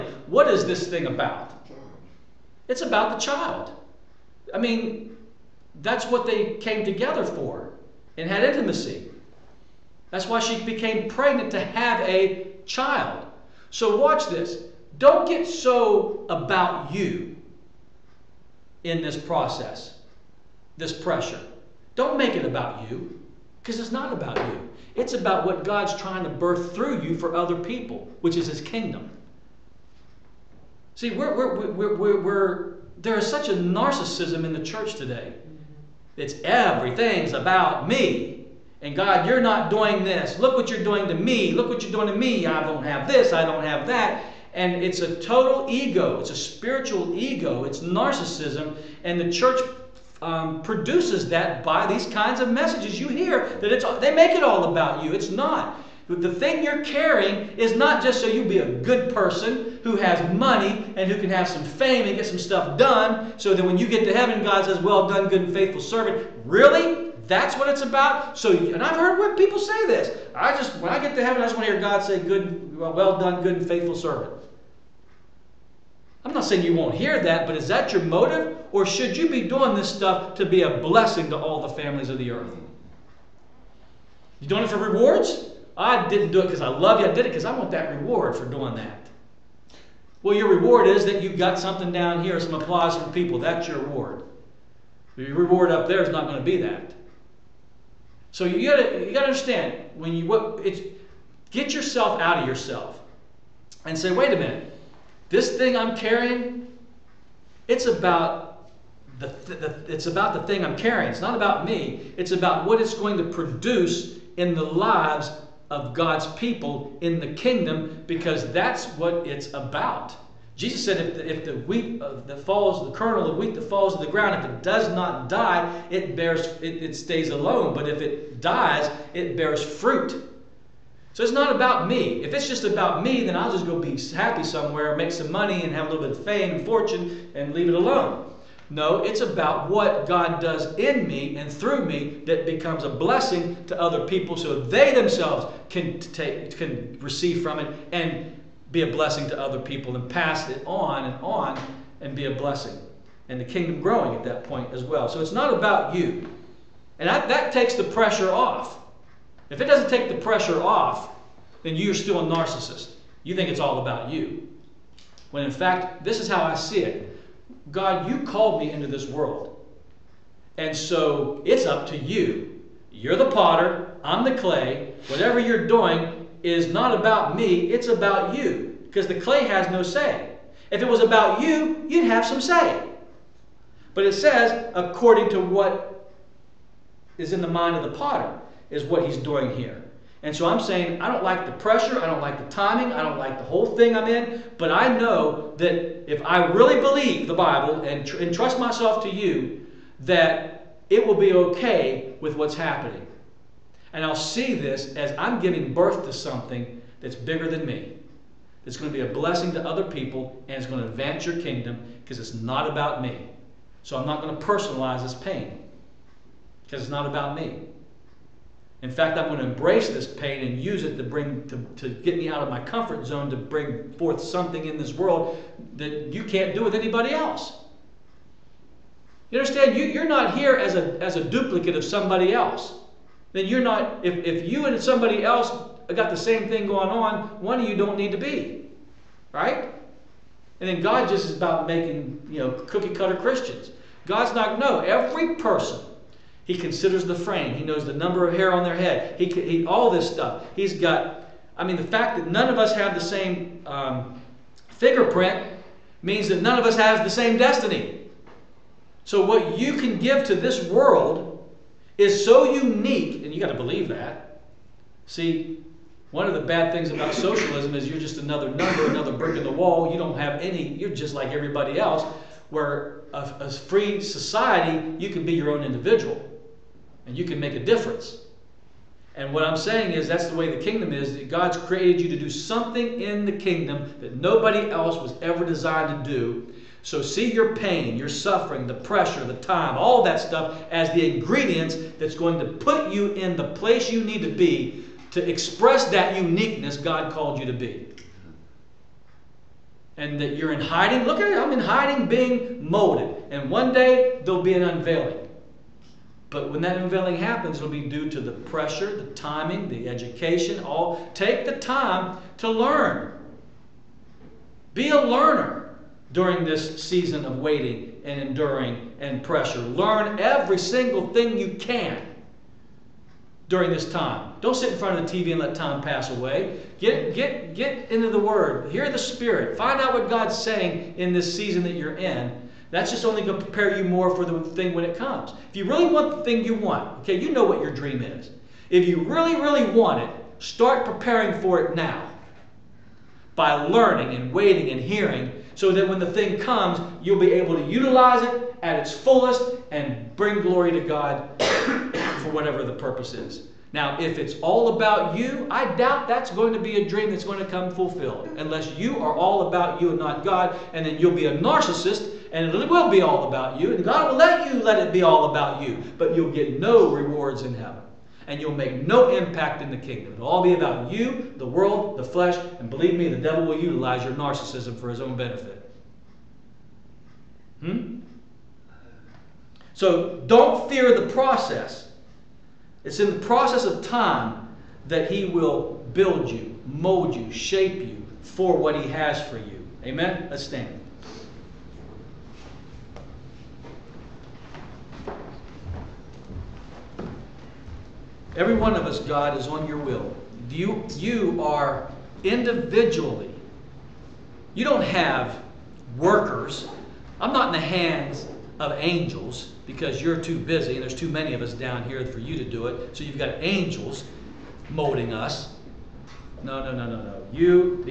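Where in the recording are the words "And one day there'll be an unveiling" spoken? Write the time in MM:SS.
05:03.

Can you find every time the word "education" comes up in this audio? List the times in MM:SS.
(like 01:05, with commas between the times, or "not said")
05:09.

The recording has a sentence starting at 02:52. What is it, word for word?
You're the potter, I'm the clay.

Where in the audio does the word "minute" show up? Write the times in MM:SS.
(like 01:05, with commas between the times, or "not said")
01:44.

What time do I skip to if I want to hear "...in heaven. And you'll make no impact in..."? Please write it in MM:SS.
06:07.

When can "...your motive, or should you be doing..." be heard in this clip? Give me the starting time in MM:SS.
01:17.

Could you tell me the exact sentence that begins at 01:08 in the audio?
So, and I've heard people say this.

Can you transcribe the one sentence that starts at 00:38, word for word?
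And God, you're not doing this.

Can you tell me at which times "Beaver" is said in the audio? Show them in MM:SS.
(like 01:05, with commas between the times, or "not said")
not said.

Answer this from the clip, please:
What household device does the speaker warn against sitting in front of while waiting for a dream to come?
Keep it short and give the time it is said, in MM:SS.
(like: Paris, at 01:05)
TV, at 05:25.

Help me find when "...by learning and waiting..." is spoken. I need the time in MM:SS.
05:43.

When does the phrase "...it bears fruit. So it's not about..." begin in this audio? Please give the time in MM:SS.
02:09.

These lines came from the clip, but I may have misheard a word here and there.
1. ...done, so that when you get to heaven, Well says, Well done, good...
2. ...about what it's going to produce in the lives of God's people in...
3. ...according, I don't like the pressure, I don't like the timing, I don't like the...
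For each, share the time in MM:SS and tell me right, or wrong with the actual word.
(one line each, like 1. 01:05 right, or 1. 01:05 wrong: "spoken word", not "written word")
1. 01:02 wrong: "God", not "Well"
2. 01:52 right
3. 03:10 wrong: "saying", not "according".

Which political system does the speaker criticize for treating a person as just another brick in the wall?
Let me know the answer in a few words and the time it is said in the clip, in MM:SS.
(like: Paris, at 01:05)
socialism, at 04:27.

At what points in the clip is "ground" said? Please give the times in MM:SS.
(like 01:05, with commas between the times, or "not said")
02:04.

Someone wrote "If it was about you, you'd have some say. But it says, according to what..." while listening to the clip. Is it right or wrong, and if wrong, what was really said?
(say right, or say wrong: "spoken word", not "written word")
right.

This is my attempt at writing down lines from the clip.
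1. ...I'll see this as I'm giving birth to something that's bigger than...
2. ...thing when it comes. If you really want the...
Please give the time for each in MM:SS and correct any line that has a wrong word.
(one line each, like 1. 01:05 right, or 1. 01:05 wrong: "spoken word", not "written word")
1. 03:24 right
2. 05:34 right.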